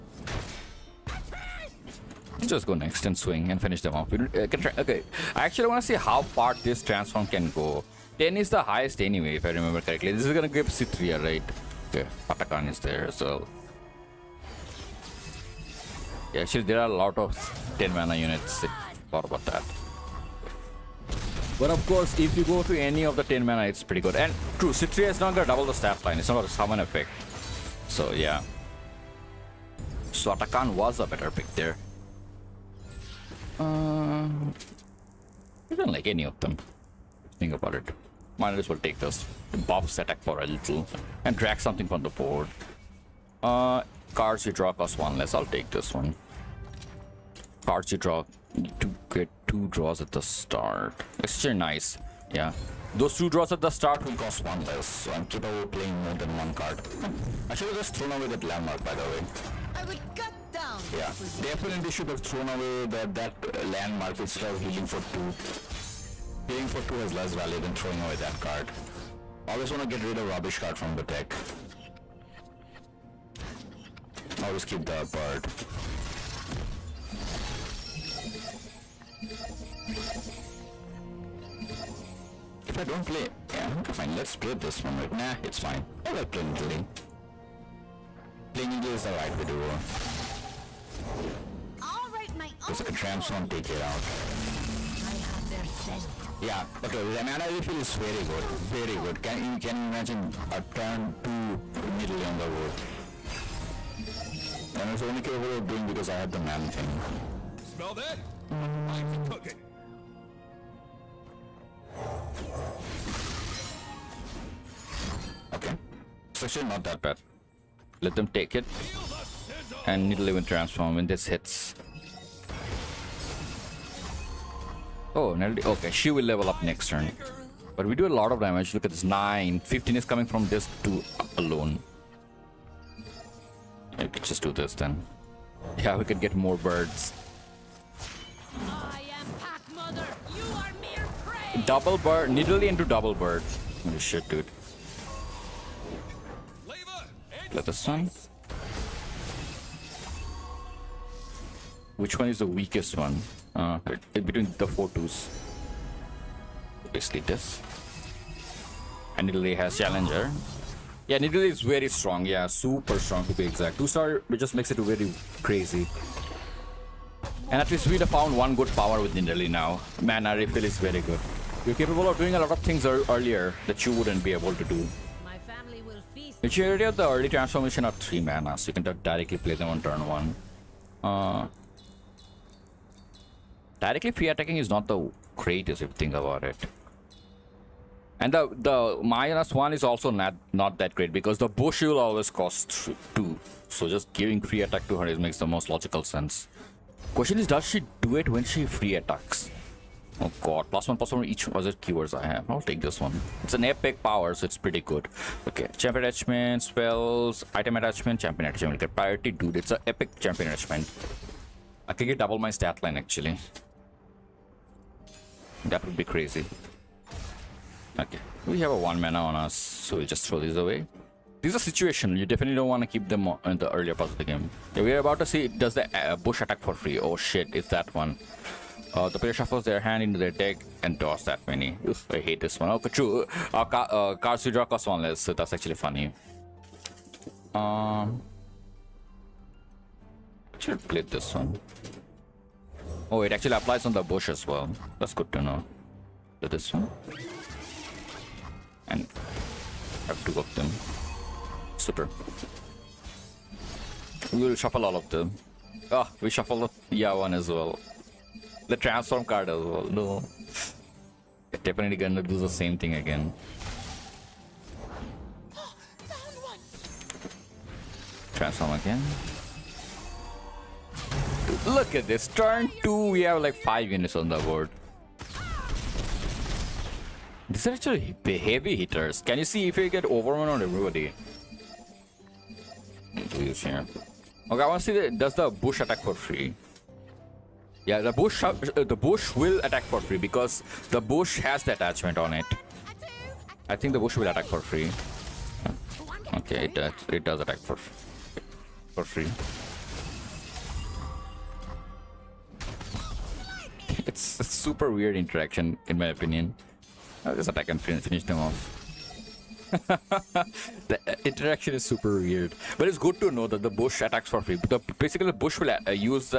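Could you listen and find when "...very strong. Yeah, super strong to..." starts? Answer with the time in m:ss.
2:41.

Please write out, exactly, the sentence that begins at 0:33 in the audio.
Uh, I don't like any of them.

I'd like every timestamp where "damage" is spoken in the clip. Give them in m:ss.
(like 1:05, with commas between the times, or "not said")
2:08.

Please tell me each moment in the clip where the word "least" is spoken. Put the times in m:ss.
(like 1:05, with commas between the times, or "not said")
2:47.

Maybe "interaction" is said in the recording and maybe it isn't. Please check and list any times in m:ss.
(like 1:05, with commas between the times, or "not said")
5:05, 5:11.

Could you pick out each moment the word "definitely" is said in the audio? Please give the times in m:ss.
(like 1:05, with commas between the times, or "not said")
1:01, 3:42, 4:21.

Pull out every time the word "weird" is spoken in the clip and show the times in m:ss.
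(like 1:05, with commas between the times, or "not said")
5:04, 5:12.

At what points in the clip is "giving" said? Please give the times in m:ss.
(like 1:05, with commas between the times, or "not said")
3:14.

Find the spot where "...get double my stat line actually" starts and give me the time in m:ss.
3:32.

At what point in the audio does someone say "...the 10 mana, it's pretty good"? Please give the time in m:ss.
0:23.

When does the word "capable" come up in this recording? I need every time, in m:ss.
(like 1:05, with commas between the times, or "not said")
0:55, 1:45, 2:51.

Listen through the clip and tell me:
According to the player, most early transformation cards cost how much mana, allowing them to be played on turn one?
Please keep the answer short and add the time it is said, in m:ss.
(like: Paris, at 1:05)
3, at 2:57.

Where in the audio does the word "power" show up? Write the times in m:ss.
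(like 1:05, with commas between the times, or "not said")
2:48, 3:24.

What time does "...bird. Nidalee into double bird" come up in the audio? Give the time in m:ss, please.
2:21.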